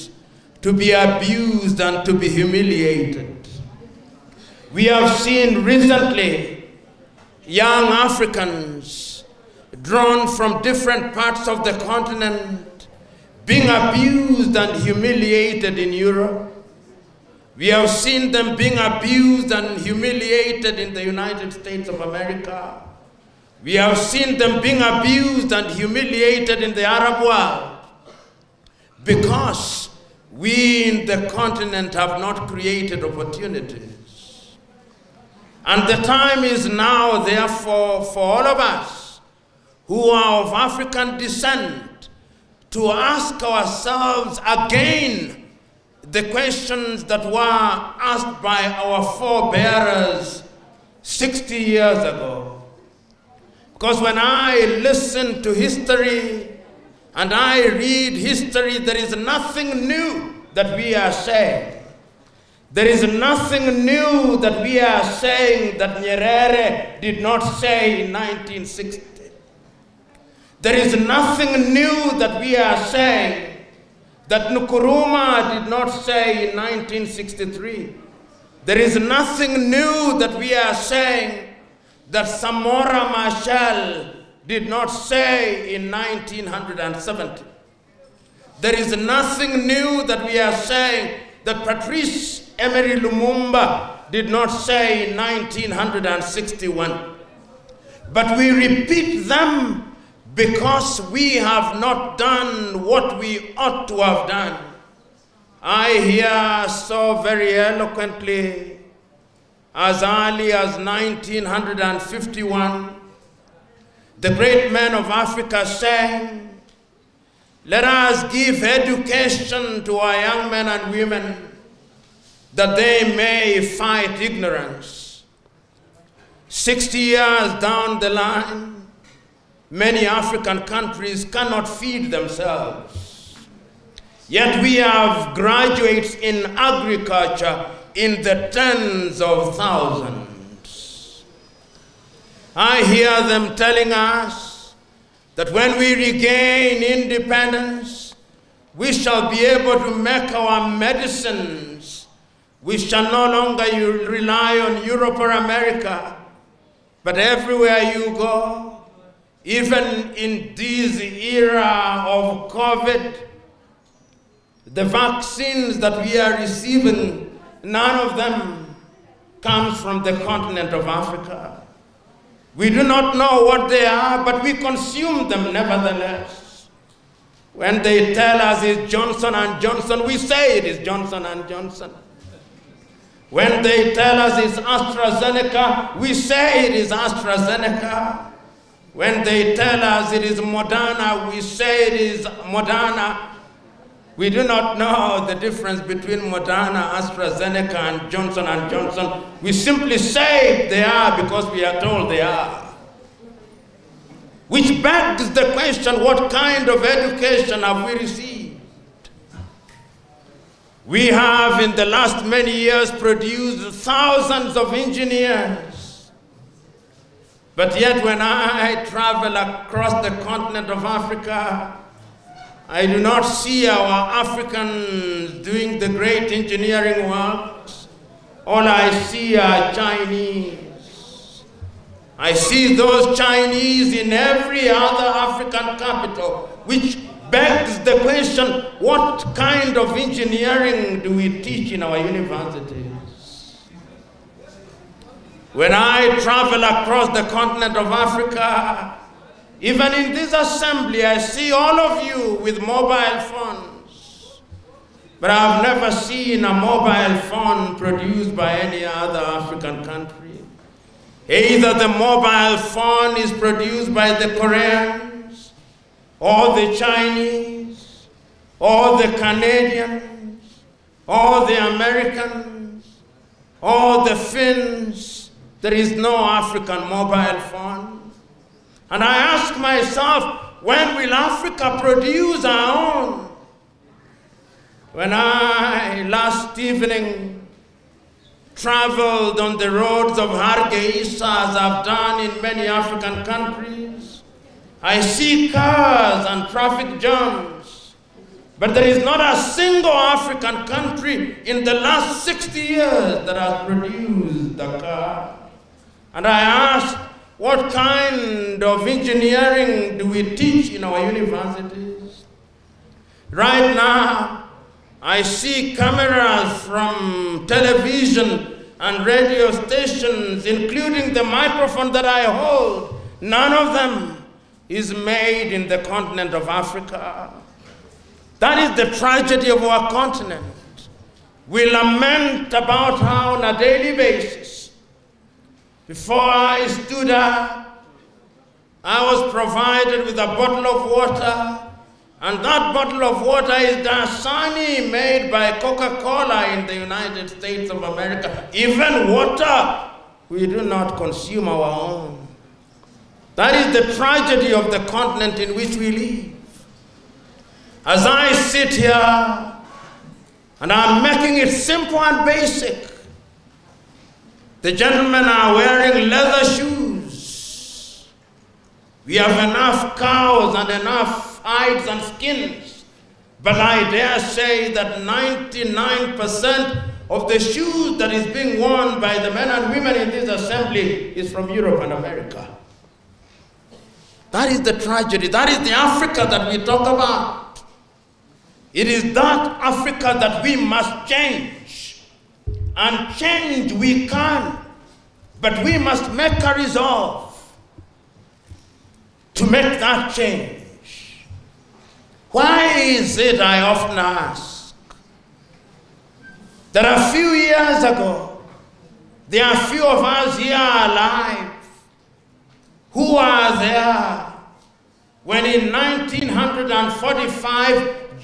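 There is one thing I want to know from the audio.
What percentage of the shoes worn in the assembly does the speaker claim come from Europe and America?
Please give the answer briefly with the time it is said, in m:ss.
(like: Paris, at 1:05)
99%, at 6:14.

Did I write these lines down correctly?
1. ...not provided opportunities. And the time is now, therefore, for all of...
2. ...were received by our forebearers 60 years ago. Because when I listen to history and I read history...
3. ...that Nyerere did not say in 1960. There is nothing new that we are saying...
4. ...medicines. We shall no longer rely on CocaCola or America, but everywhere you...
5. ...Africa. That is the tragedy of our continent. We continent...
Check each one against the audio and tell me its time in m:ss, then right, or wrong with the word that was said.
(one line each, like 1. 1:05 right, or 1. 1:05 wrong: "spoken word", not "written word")
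1. 0:32 wrong: "created", not "provided"
2. 0:47 wrong: "asked", not "received"
3. 1:05 right
4. 2:30 wrong: "Europe", not "CocaCola"
5. 5:26 wrong: "lament", not "continent".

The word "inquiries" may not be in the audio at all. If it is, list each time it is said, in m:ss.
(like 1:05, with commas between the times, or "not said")
not said.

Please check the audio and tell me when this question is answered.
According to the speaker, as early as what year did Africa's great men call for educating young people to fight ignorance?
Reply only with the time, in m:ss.
1:50.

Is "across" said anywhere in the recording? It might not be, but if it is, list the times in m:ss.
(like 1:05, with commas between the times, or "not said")
3:39, 4:06.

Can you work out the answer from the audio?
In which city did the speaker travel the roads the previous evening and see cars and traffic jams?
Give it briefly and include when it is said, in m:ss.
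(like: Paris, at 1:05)
Hargeisa, at 4:50.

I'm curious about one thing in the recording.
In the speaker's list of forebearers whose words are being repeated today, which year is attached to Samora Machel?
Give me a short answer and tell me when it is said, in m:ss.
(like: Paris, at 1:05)
1970, at 1:25.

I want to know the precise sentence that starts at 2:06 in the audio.
60 years down the line, Many African countries cannot feed themselves.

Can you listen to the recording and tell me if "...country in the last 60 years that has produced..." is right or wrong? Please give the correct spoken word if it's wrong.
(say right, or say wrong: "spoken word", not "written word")
right.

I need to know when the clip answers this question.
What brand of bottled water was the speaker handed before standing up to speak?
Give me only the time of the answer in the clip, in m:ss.
5:43.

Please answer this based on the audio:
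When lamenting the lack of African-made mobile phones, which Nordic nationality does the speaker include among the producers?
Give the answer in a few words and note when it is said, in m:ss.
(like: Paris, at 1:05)
the Finns, at 4:34.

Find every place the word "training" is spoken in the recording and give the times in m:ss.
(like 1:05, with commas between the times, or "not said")
not said.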